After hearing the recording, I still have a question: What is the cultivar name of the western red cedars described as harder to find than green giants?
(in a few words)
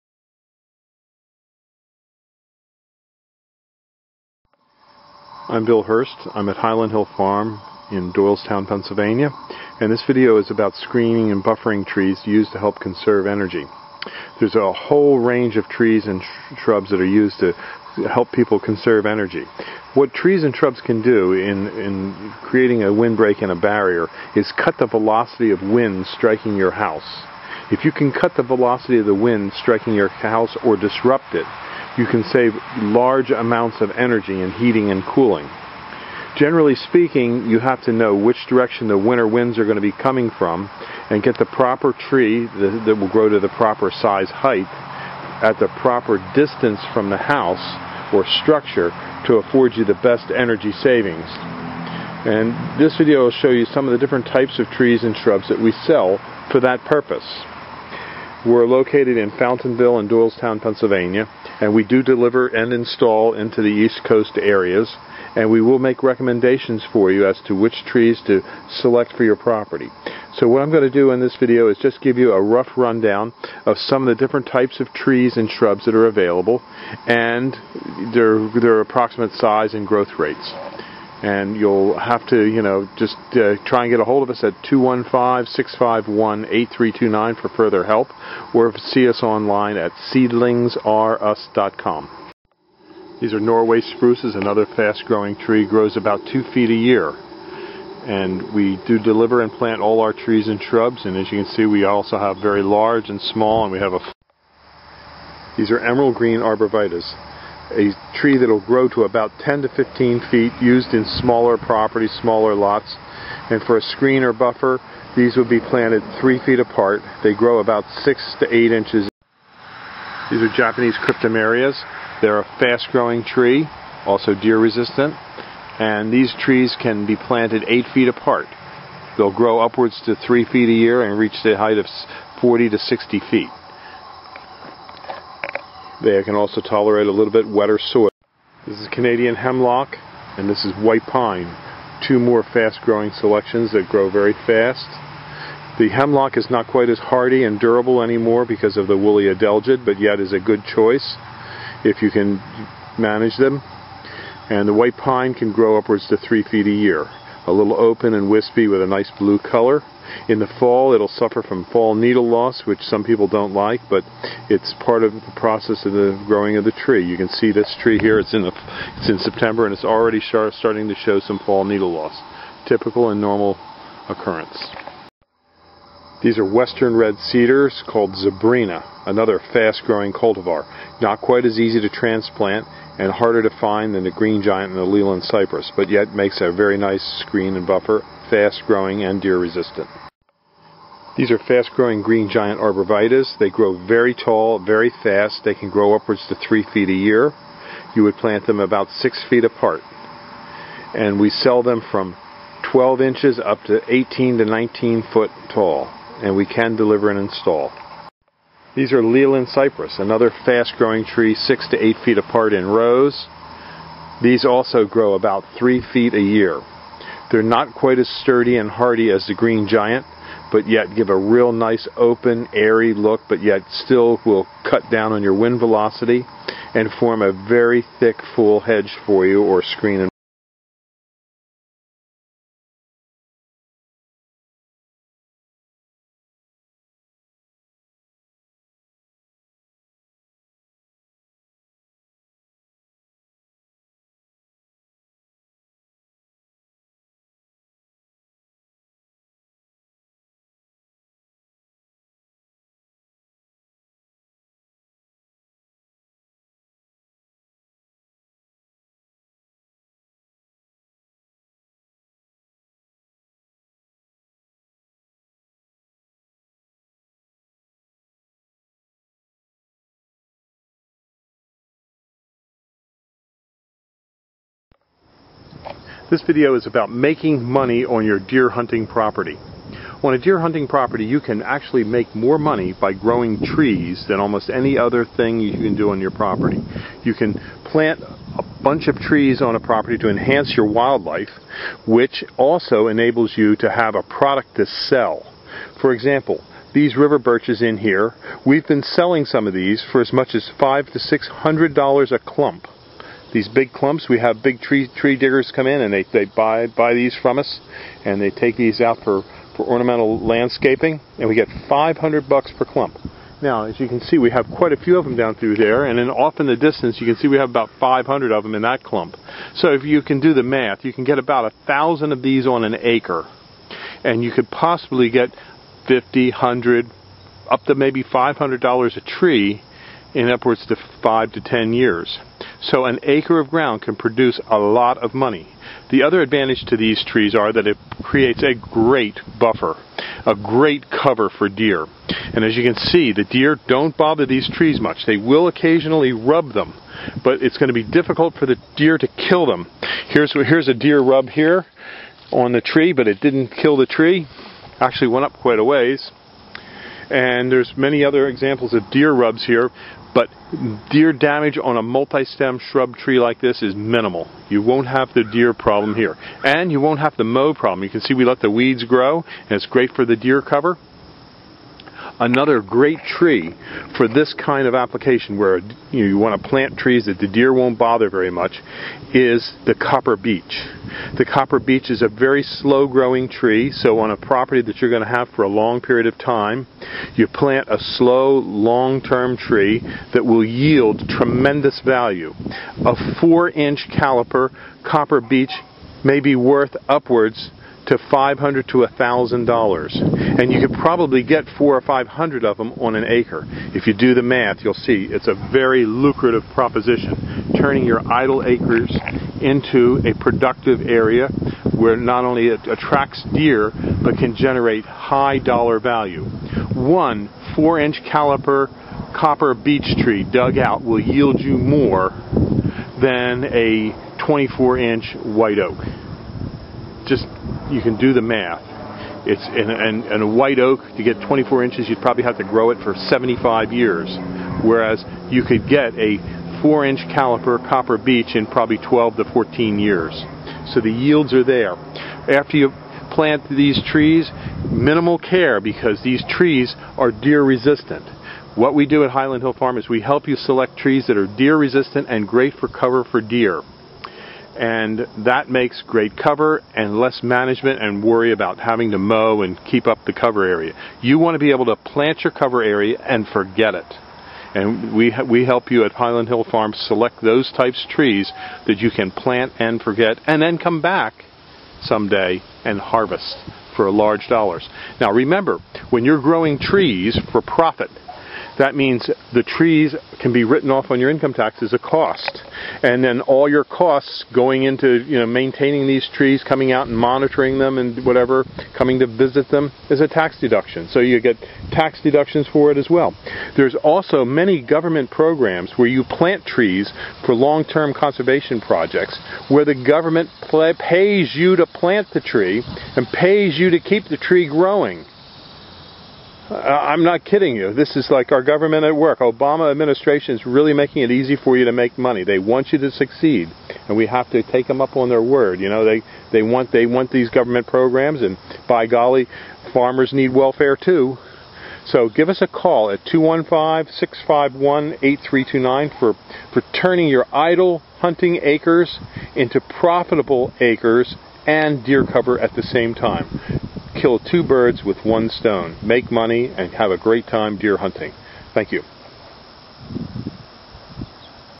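Zebrina.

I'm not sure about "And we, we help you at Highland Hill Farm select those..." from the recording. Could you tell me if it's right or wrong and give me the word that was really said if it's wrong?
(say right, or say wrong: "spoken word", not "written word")
right.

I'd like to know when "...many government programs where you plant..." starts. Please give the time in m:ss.
8:14.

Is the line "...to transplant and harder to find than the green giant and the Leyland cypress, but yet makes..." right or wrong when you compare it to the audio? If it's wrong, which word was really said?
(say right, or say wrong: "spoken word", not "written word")
right.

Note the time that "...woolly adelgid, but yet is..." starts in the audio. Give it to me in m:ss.
2:28.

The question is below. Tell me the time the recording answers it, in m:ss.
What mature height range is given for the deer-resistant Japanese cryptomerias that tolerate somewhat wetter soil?
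2:12.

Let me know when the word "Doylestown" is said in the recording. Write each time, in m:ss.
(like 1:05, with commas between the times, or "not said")
0:08, 1:00.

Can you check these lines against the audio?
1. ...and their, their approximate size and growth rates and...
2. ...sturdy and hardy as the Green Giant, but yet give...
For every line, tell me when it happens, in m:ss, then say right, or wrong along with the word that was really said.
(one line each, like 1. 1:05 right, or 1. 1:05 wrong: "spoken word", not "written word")
1. 1:17 right
2. 3:38 right.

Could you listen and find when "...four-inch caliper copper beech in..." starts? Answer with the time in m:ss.
7:16.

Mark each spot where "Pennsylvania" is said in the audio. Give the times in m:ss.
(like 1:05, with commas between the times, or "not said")
0:08, 1:00.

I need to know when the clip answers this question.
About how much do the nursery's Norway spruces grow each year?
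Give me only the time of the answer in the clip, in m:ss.
1:36.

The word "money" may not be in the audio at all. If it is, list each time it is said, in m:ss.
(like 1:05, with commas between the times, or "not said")
4:37, 4:42, 5:35, 8:31, 8:56.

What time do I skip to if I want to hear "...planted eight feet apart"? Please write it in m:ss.
2:07.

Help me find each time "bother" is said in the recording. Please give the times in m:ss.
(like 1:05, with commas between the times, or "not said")
5:43, 6:17.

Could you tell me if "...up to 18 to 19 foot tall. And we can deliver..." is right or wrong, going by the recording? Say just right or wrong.
right.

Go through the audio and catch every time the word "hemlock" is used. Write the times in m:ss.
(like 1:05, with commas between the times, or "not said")
2:19, 2:25.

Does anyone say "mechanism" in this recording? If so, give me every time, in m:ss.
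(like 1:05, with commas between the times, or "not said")
not said.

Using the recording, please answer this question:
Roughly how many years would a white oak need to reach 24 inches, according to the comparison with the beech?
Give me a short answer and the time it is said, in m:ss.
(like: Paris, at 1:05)
75 years, at 7:12.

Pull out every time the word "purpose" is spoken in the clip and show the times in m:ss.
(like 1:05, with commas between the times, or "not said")
0:56.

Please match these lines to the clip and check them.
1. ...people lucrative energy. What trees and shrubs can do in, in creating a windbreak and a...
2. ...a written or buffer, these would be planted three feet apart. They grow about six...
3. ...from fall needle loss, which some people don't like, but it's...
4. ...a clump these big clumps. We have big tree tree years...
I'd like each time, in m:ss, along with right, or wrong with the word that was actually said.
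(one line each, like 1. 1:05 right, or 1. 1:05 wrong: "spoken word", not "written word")
1. 0:18 wrong: "conserve", not "lucrative"
2. 1:53 wrong: "screen", not "written"
3. 2:41 right
4. 5:02 wrong: "diggers", not "years".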